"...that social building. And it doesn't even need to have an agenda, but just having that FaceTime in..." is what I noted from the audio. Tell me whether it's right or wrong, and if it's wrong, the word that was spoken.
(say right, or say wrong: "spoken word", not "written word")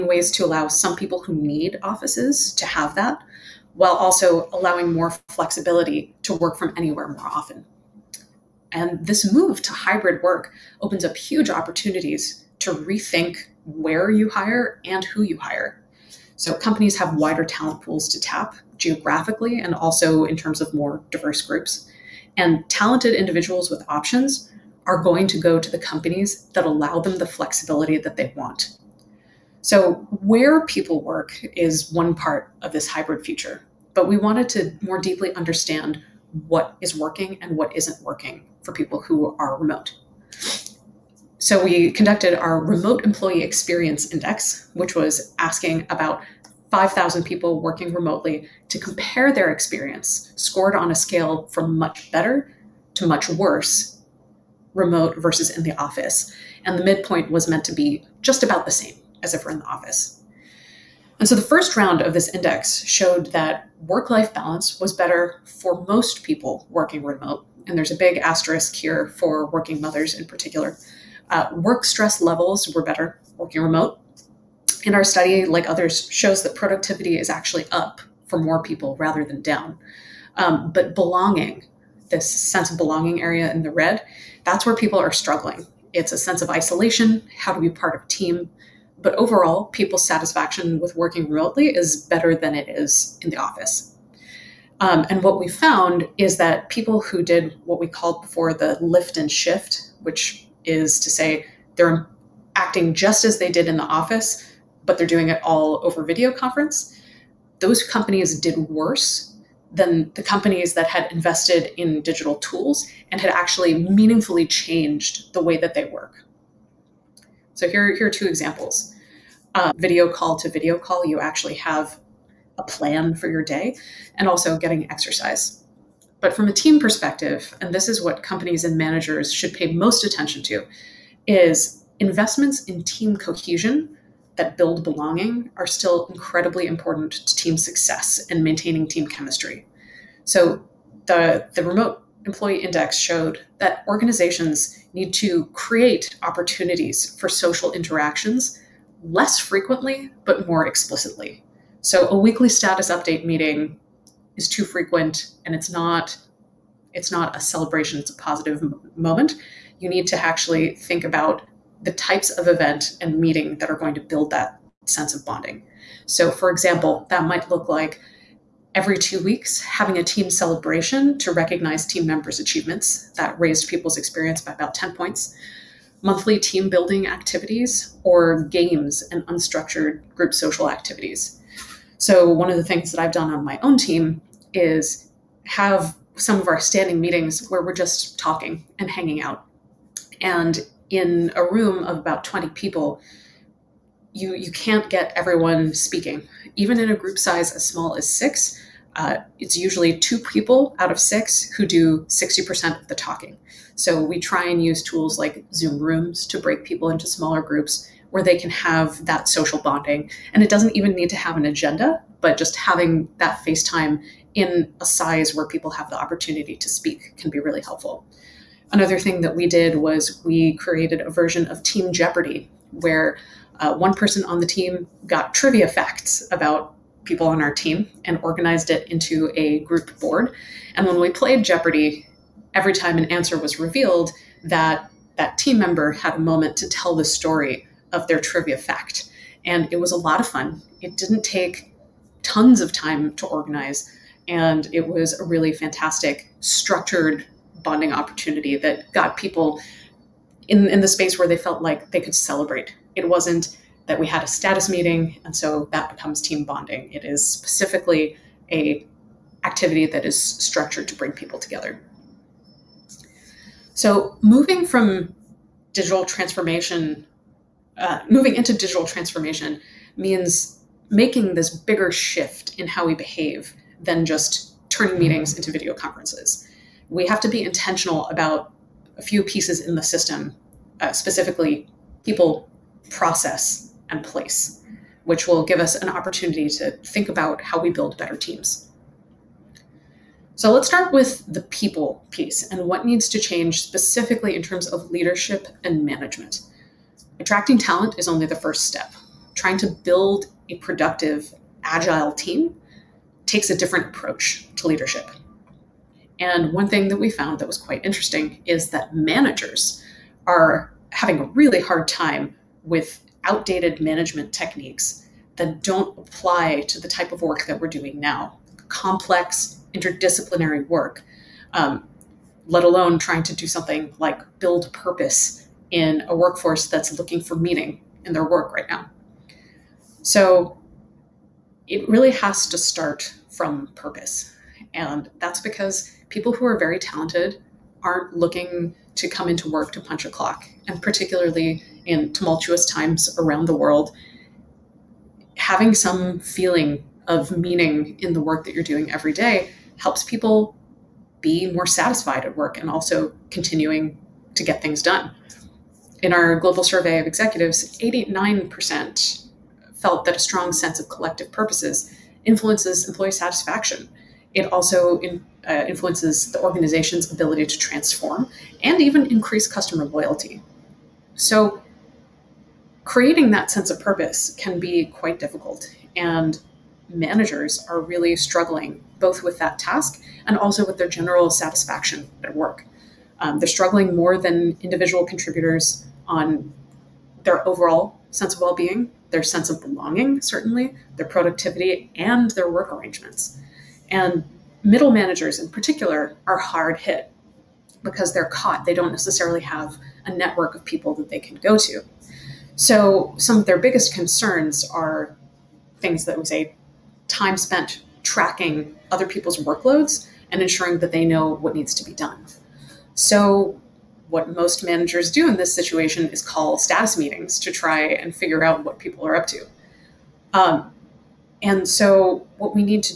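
wrong: "bonding", not "building".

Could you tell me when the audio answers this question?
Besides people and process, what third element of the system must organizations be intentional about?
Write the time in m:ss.
4:44.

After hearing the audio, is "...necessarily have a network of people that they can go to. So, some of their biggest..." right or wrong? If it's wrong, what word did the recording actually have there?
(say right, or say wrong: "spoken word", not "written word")
right.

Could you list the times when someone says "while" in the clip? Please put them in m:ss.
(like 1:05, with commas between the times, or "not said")
0:03.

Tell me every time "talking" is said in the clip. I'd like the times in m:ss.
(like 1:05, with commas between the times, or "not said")
3:08, 3:22.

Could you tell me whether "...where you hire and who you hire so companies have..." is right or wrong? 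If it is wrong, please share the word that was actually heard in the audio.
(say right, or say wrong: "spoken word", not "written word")
right.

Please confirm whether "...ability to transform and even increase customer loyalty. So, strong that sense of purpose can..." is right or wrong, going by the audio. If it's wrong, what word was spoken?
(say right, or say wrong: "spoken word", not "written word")
wrong: "creating", not "strong".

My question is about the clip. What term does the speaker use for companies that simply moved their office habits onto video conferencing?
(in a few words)
lift and shift.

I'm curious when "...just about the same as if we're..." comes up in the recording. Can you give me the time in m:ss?
0:58.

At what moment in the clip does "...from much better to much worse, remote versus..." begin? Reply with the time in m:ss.
0:51.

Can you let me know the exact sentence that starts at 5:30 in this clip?
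So it really has to start from purpose.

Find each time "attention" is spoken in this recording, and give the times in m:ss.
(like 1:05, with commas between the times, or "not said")
2:10.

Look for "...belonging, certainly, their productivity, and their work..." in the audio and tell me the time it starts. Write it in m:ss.
6:29.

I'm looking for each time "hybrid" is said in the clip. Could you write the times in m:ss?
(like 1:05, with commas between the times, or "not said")
0:09, 0:32.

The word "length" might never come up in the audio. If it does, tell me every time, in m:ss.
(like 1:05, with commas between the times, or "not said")
not said.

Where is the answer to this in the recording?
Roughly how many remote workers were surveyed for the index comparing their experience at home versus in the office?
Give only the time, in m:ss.
0:46.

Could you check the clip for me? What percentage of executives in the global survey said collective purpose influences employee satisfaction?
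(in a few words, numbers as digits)
89%.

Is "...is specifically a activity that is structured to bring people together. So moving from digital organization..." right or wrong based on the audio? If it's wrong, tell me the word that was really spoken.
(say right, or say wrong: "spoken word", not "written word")
wrong: "transformation", not "organization".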